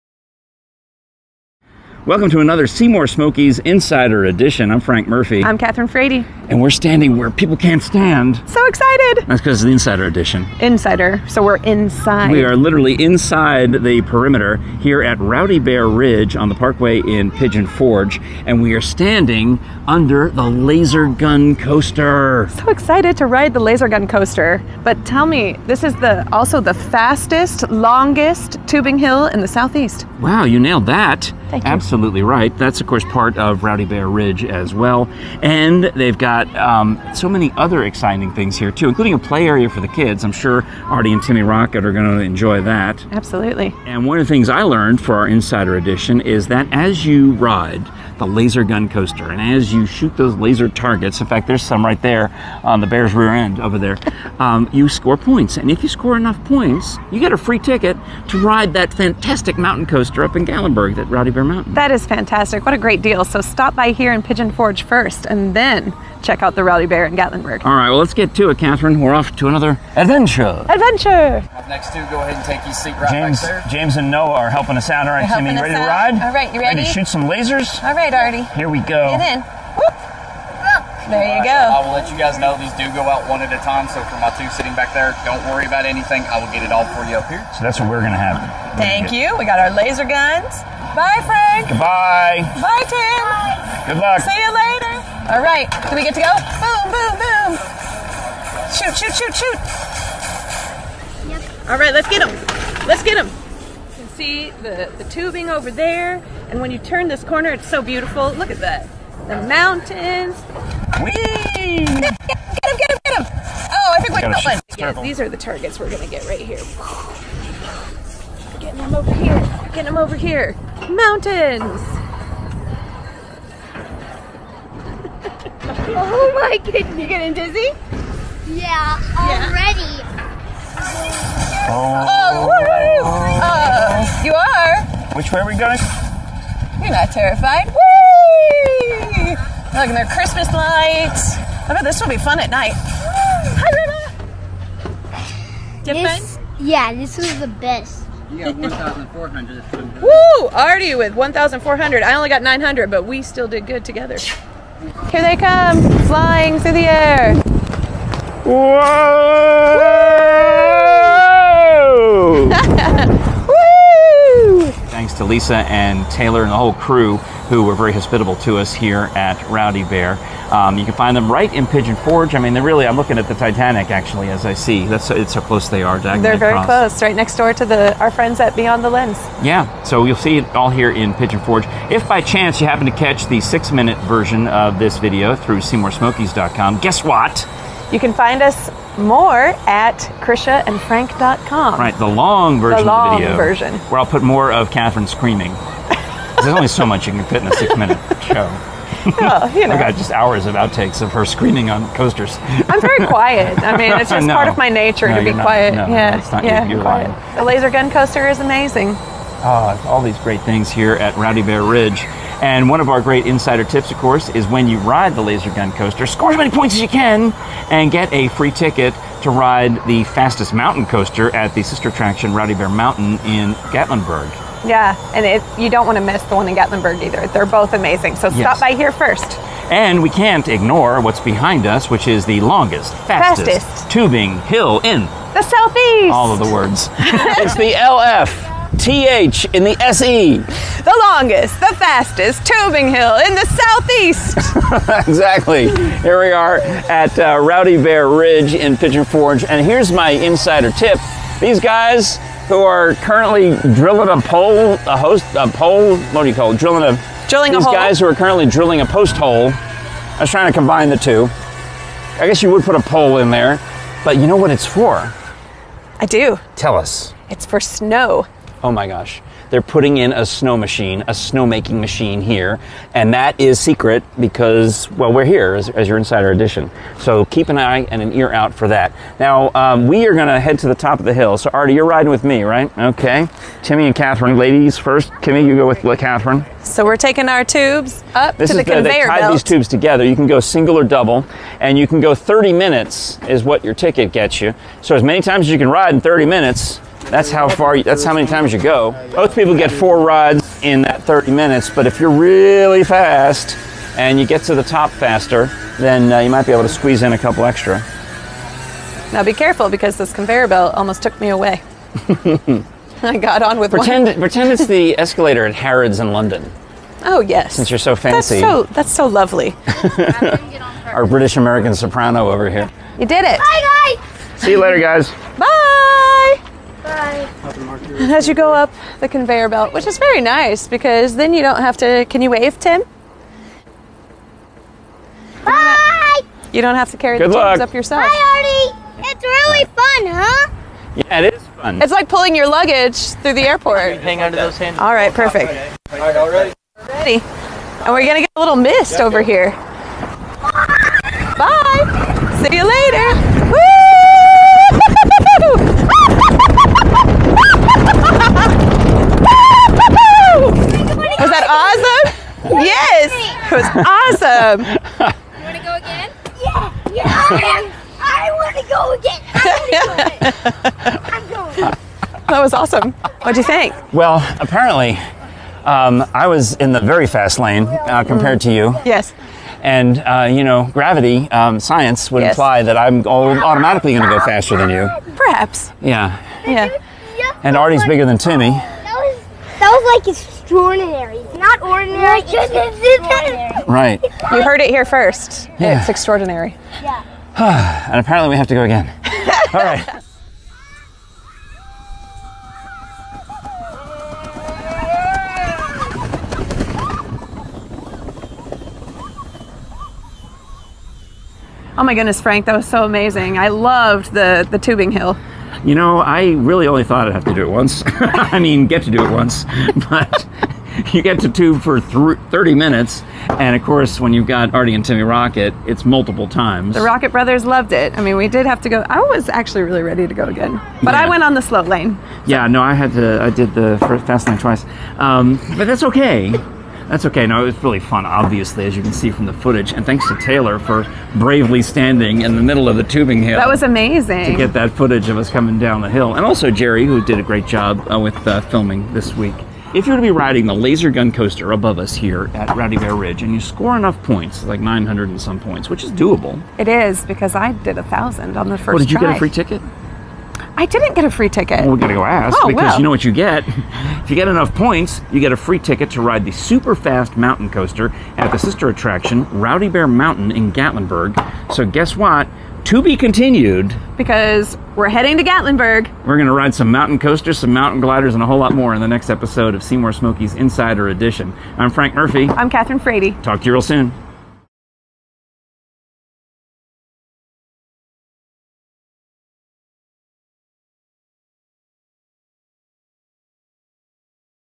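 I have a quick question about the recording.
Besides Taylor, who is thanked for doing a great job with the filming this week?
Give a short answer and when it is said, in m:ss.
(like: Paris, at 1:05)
Jerry, at 7:26.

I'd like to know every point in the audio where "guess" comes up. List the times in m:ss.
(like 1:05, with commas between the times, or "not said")
3:06, 4:22, 7:51.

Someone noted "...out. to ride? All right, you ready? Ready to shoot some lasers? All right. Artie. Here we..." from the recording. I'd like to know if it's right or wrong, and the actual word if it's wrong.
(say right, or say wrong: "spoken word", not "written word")
right.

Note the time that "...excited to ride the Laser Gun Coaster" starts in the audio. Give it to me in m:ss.
0:22.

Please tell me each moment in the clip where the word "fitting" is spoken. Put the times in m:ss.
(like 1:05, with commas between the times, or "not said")
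not said.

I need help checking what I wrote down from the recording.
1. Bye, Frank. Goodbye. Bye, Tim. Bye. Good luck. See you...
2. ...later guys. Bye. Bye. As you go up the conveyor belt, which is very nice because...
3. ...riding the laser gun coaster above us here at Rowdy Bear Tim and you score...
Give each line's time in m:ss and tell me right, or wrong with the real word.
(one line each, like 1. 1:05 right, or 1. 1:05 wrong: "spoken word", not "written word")
1. 1:30 right
2. 5:24 right
3. 7:30 wrong: "Ridge", not "Tim".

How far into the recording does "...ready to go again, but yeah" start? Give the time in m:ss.
7:09.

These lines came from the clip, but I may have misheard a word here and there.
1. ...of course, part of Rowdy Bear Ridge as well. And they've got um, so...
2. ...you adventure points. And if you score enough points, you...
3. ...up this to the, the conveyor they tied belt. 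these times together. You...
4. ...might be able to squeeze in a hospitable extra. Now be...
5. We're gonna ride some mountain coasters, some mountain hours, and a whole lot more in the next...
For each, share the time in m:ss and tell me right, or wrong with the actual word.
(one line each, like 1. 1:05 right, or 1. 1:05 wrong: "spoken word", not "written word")
1. 0:32 right
2. 0:54 wrong: "score", not "adventure"
3. 4:48 wrong: "tubes", not "times"
4. 5:06 wrong: "couple", not "hospitable"
5. 7:56 wrong: "gliders", not "hours".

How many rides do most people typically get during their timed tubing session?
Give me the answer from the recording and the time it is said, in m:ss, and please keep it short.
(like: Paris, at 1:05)
4, at 4:59.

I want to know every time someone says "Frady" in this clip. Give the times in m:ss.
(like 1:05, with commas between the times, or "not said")
0:05, 8:02.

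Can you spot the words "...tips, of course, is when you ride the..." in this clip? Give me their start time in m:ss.
3:33.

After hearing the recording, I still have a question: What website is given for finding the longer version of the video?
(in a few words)
KrishaandFrank.com.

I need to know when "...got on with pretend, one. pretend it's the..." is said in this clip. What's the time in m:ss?
5:13.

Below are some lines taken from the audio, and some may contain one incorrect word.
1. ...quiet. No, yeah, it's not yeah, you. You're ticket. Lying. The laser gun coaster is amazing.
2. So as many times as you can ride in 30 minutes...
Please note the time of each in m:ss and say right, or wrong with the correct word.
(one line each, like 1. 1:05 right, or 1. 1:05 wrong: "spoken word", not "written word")
1. 3:25 wrong: "quiet", not "ticket"
2. 4:54 right.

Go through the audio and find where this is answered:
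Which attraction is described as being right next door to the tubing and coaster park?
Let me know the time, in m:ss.
2:58.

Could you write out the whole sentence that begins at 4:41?
So, Artie, you're riding with me, right?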